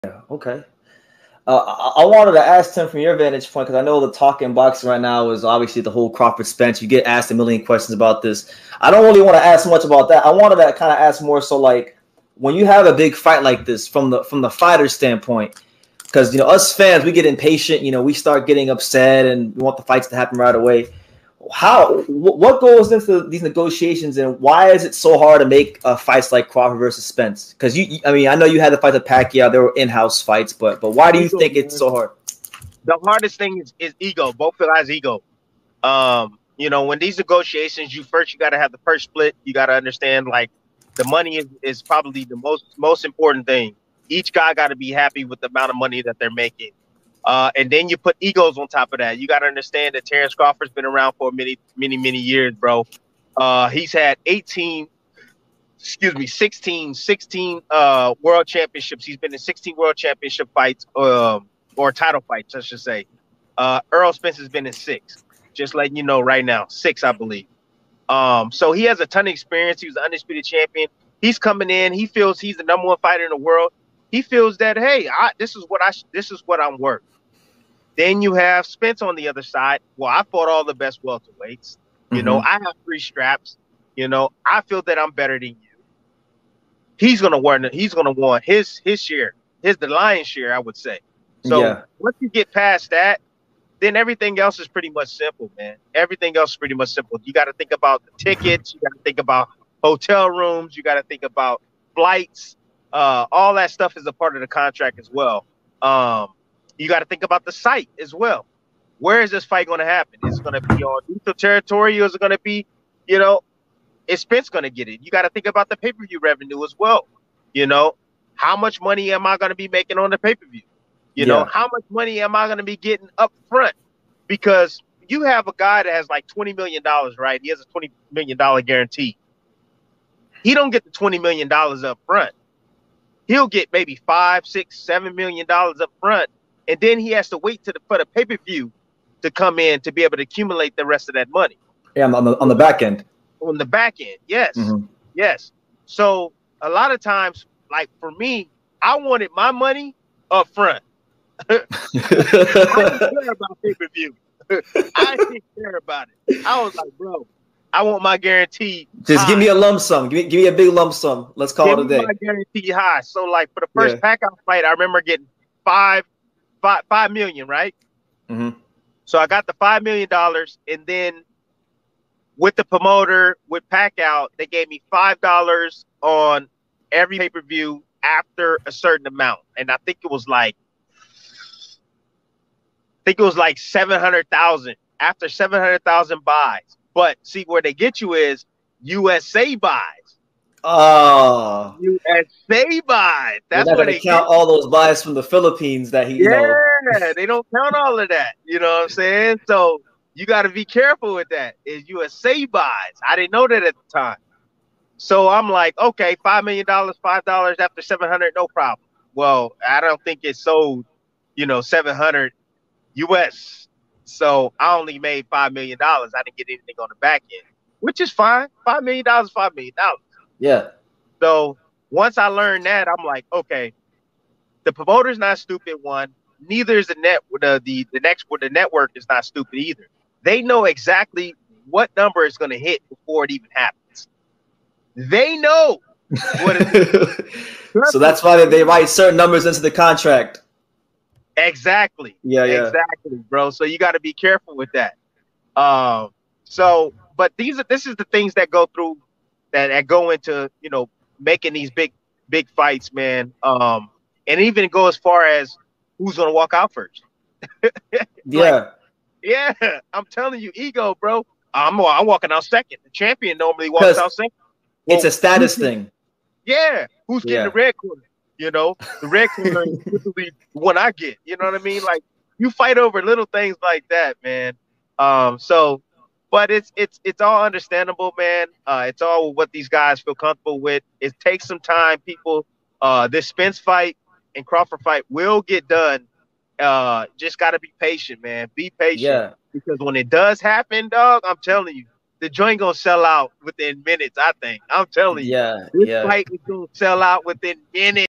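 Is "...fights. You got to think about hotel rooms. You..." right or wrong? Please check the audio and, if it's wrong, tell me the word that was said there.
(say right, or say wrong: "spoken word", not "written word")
wrong: "tickets", not "fights".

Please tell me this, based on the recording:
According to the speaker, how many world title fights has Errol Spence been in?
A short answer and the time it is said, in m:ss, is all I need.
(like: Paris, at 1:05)
6, at 1:03.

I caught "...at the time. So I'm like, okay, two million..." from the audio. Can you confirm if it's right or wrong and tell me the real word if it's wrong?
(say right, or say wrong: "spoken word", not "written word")
wrong: "five", not "two".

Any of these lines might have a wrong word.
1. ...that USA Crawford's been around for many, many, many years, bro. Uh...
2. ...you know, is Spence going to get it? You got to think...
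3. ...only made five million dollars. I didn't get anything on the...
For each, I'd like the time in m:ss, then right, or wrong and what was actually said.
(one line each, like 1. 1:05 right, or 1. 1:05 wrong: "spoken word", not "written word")
1. 0:49 wrong: "Terence", not "USA"
2. 1:53 right
3. 3:34 right.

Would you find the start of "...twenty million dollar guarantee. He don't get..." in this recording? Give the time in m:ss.
2:07.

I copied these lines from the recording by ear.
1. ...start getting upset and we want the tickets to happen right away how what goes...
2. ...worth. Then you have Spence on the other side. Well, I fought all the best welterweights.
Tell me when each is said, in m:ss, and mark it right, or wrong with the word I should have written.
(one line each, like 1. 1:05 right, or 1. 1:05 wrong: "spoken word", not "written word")
1. 0:18 wrong: "fights", not "tickets"
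2. 1:16 right.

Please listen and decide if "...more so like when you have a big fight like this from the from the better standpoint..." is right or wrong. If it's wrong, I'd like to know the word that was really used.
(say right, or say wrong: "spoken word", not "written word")
wrong: "fighter", not "better".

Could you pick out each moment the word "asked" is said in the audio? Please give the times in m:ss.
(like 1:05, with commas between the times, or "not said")
0:07.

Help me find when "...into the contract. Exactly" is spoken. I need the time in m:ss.
3:59.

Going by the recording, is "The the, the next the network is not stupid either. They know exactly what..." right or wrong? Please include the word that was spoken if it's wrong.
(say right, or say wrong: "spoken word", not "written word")
right.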